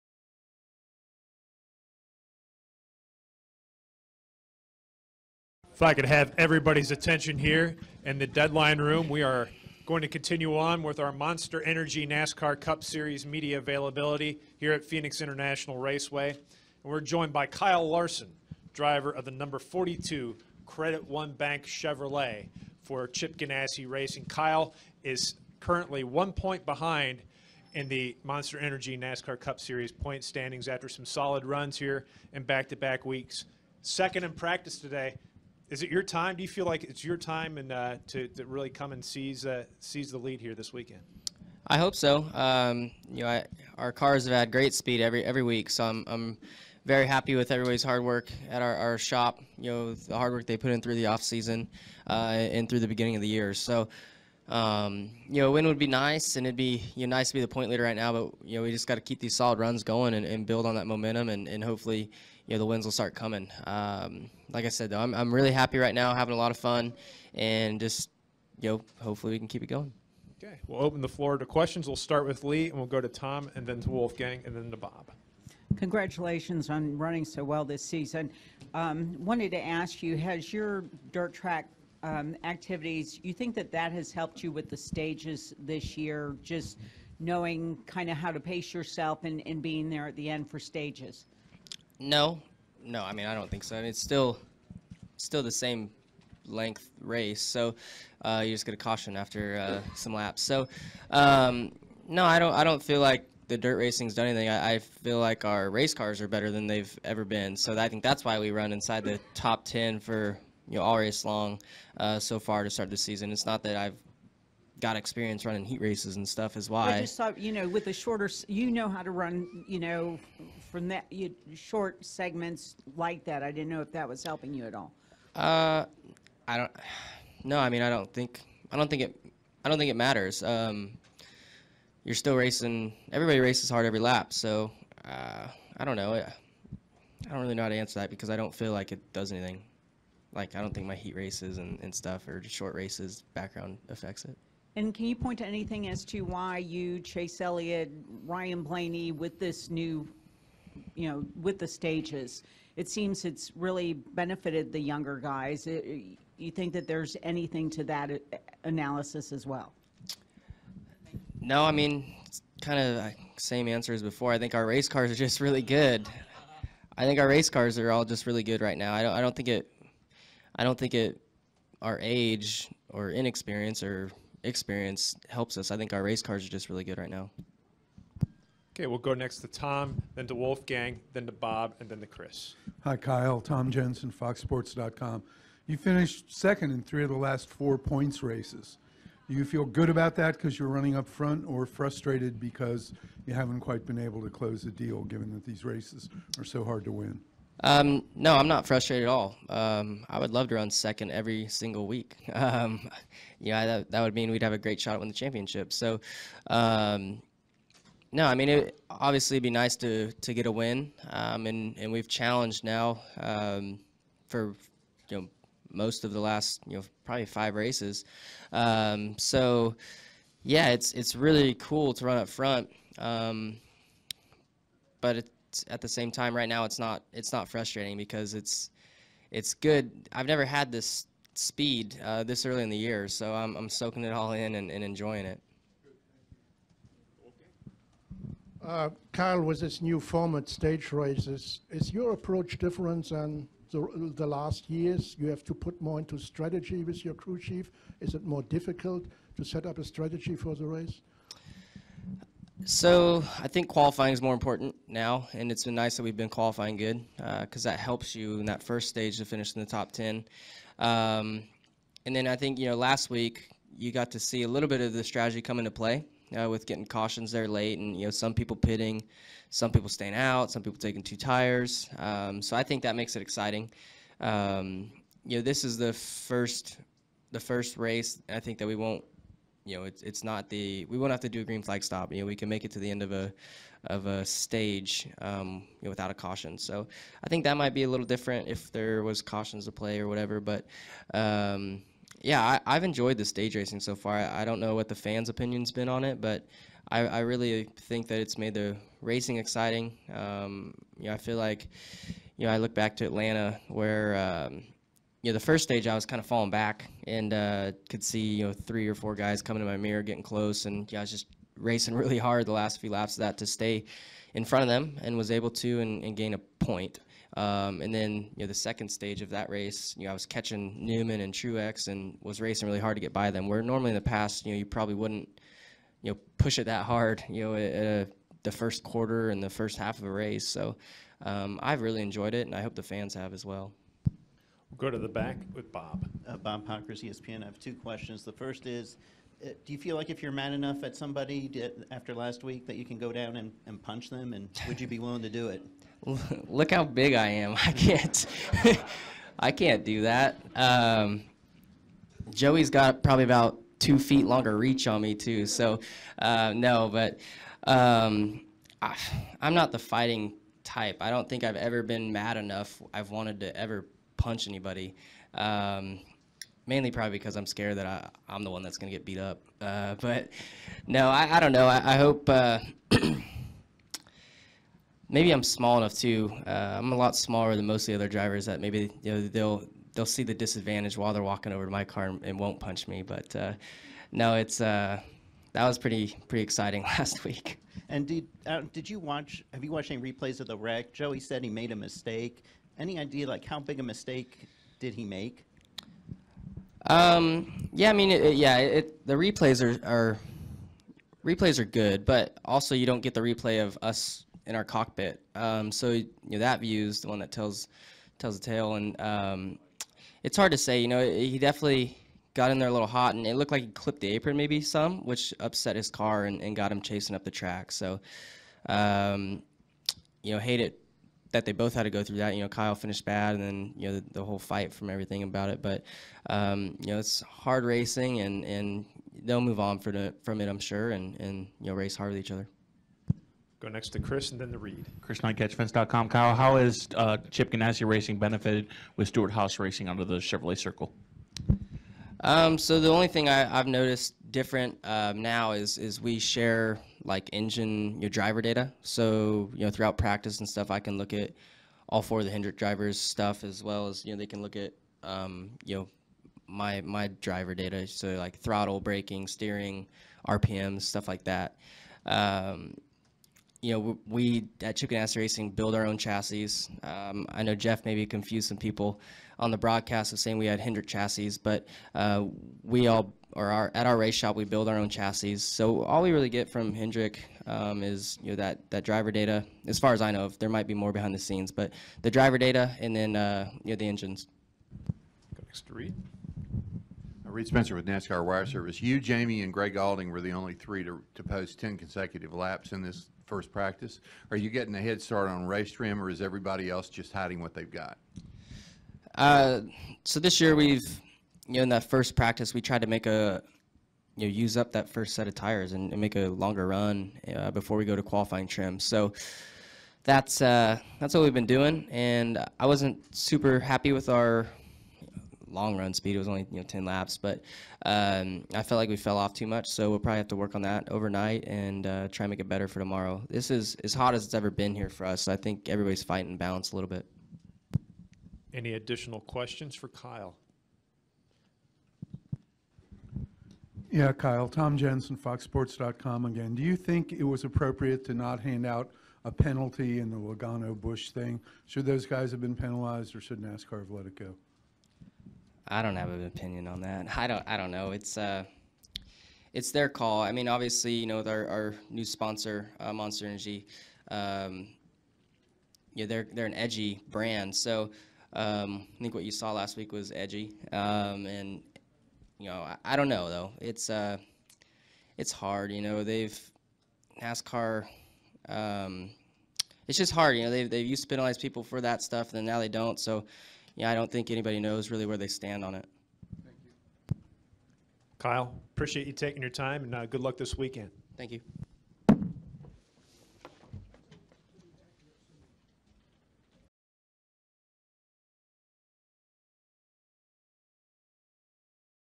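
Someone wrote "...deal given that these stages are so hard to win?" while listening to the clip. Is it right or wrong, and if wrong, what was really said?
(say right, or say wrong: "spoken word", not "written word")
wrong: "races", not "stages".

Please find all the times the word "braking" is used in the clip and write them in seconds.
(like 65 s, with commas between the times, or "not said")
458 s.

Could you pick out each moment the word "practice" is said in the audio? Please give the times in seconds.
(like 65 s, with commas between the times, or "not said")
34 s, 449 s, 493 s, 502 s.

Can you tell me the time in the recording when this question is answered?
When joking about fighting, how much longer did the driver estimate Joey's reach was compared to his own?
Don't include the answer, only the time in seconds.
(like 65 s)
353 s.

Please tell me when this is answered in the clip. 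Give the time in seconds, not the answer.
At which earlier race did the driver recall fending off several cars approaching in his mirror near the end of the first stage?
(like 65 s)
303 s.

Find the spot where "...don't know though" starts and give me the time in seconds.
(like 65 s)
562 s.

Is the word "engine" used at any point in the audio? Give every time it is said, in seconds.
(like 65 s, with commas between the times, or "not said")
447 s, 483 s.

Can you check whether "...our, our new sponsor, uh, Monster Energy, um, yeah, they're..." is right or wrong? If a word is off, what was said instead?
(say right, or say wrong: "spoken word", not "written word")
right.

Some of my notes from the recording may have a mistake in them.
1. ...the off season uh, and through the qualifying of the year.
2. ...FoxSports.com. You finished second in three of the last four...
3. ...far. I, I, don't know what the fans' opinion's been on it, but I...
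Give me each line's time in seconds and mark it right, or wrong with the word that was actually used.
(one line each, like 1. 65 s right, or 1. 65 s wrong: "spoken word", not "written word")
1. 50 s wrong: "beginning", not "qualifying"
2. 184 s right
3. 293 s right.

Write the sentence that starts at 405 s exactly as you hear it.
Um, so you know, that view is the one that tells tells the tale, and um, it's hard to say.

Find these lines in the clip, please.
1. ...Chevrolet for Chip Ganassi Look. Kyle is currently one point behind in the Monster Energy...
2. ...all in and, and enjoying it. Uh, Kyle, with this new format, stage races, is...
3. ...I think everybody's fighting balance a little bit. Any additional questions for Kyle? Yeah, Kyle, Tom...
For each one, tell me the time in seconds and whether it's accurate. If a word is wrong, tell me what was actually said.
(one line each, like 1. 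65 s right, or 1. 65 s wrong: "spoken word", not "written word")
1. 21 s wrong: "Racing", not "Look"
2. 234 s right
3. 525 s right.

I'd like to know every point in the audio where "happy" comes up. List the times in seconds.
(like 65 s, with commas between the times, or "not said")
47 s, 65 s, 513 s.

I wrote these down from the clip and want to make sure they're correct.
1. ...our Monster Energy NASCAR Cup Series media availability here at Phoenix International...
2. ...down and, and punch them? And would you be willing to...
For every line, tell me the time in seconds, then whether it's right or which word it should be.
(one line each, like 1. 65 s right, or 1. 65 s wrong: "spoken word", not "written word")
1. 10 s right
2. 343 s right.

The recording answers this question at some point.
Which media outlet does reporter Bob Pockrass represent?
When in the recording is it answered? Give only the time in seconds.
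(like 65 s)
337 s.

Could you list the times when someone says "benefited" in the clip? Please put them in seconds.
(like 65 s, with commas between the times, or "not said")
153 s, 438 s.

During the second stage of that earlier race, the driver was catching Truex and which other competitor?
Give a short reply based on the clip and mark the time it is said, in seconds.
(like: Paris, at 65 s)
Newman, at 320 s.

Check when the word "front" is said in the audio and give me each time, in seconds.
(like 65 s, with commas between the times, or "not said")
191 s, 222 s, 314 s.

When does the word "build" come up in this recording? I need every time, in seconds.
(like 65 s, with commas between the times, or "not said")
60 s, 465 s, 474 s.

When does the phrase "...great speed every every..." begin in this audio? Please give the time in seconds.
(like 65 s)
44 s.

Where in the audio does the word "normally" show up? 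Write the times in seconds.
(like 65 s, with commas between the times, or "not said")
323 s.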